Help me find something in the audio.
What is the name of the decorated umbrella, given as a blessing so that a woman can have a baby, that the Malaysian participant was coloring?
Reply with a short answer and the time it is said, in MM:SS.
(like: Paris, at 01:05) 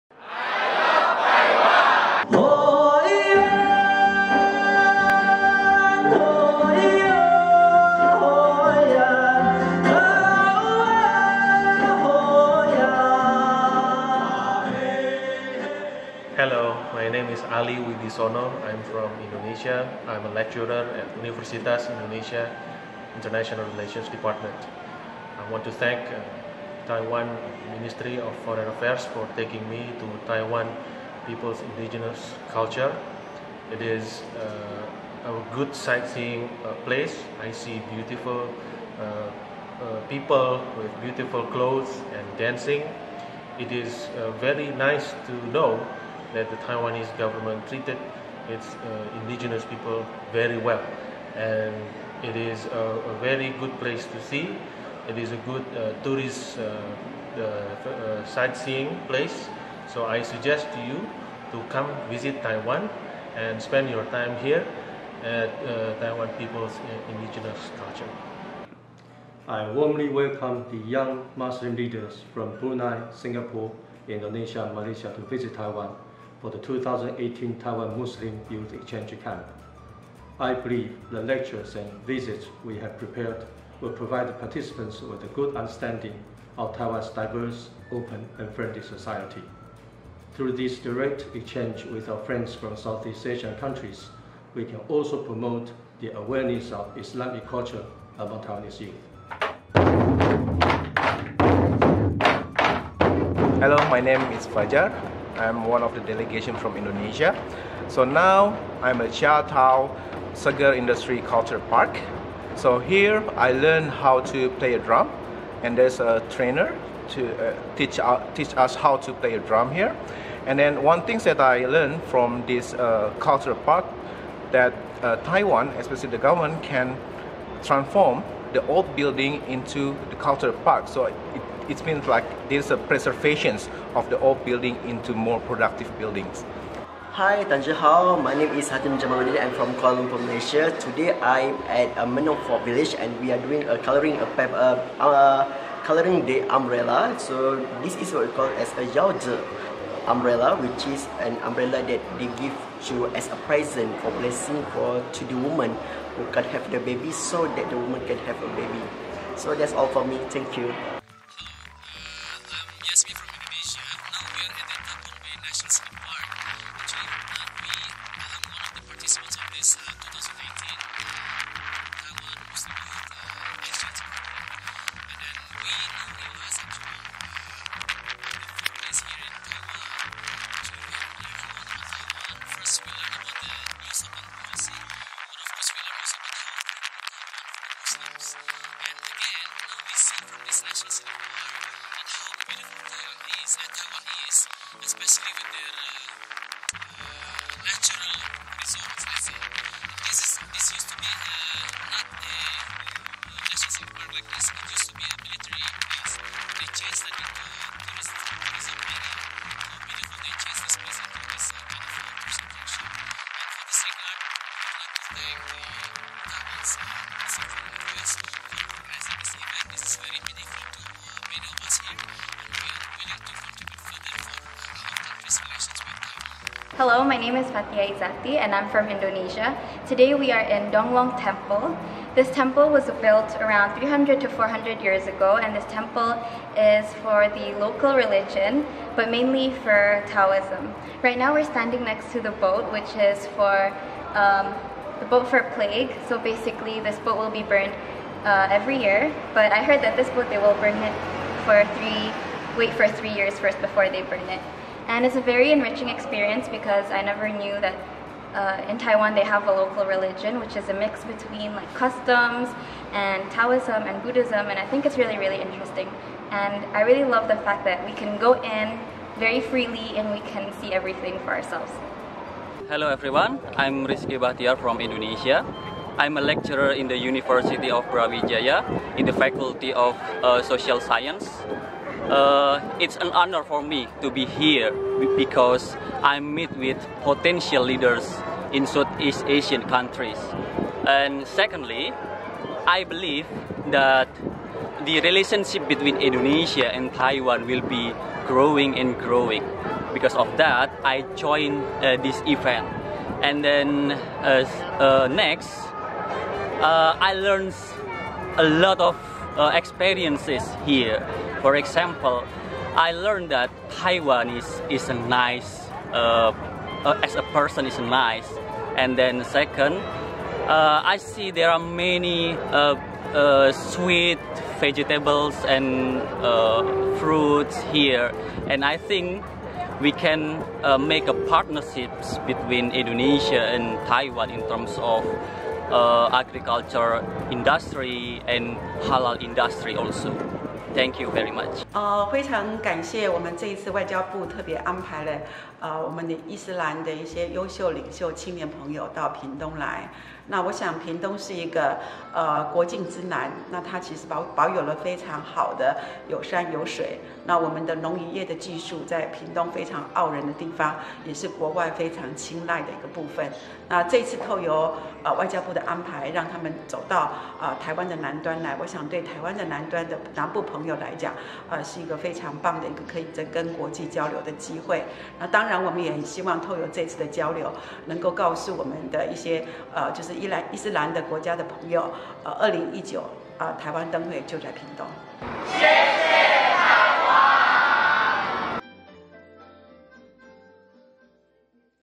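yaozi umbrella, at 02:28.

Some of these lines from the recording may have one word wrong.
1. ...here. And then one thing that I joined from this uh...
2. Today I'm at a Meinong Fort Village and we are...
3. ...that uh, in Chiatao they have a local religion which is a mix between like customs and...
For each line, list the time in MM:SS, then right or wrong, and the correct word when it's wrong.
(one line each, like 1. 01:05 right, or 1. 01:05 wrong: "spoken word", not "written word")
1. 01:59 wrong: "learned", not "joined"
2. 02:20 right
3. 04:17 wrong: "Taiwan", not "Chiatao".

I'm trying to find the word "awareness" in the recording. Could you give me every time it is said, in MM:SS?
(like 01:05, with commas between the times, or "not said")
01:36.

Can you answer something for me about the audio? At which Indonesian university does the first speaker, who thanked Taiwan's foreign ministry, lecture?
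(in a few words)
Universitas Indonesia.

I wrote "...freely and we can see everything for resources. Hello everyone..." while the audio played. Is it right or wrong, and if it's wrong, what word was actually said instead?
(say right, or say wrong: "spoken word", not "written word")
wrong: "ourselves", not "resources".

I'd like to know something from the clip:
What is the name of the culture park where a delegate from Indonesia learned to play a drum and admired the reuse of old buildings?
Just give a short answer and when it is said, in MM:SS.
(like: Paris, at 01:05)
Chia Chiatao Sugar Industry Culture Park, at 01:49.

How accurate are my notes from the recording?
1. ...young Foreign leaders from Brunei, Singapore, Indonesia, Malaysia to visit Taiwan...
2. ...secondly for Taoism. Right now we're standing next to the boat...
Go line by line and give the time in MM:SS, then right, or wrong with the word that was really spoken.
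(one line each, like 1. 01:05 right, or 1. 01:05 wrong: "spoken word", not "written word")
1. 01:10 wrong: "Muslim", not "Foreign"
2. 03:59 wrong: "mainly", not "secondly".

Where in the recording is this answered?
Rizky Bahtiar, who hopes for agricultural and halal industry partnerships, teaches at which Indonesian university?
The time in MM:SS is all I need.
04:36.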